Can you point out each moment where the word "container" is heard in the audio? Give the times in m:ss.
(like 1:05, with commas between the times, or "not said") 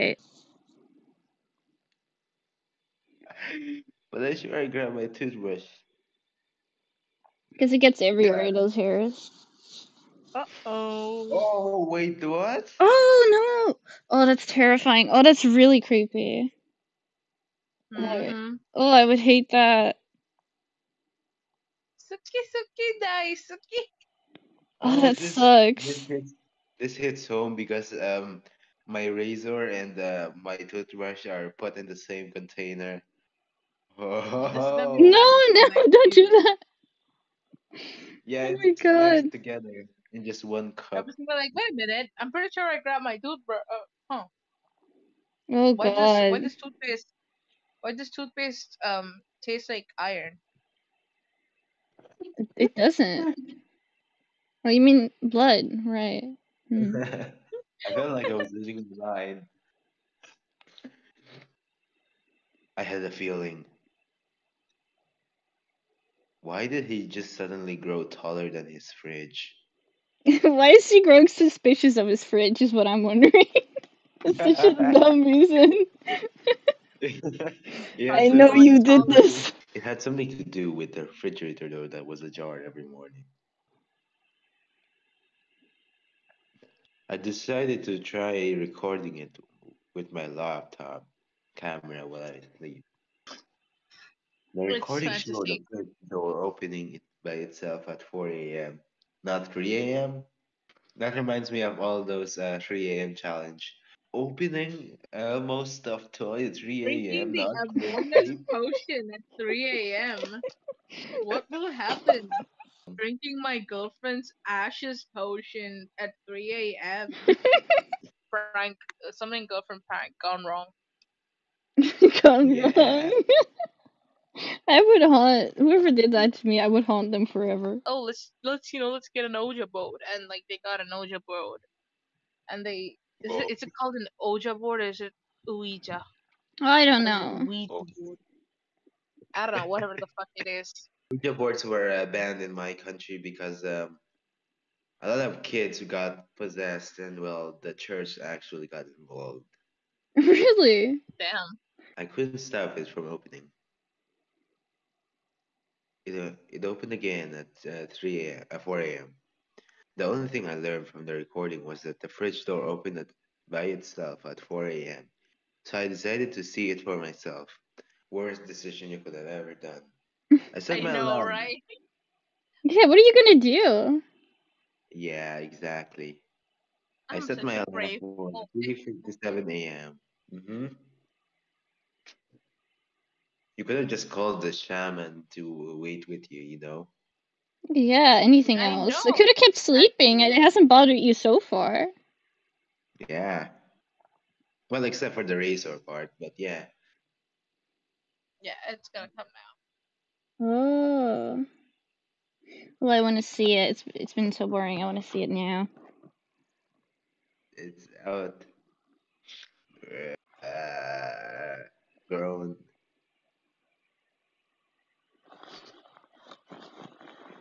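0:32.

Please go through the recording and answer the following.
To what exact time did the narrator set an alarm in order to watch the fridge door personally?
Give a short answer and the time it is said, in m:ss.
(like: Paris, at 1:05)
3:57 a.m., at 2:58.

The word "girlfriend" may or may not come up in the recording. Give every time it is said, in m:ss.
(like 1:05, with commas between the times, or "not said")
1:53, 1:59.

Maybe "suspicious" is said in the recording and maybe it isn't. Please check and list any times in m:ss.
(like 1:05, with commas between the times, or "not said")
1:11.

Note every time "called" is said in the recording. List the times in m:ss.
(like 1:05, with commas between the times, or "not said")
2:13, 3:04.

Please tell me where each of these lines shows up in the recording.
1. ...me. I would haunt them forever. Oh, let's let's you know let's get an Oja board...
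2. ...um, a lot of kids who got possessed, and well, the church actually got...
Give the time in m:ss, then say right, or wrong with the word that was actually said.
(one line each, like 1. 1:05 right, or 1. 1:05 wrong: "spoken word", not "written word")
1. 2:06 right
2. 2:23 right.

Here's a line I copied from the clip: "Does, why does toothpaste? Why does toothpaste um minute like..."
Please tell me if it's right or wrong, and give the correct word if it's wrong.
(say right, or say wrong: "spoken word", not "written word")
wrong: "taste", not "minute".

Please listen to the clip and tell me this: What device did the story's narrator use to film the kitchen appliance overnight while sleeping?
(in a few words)
laptop camera.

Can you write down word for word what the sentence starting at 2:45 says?
So I decided to see it for myself.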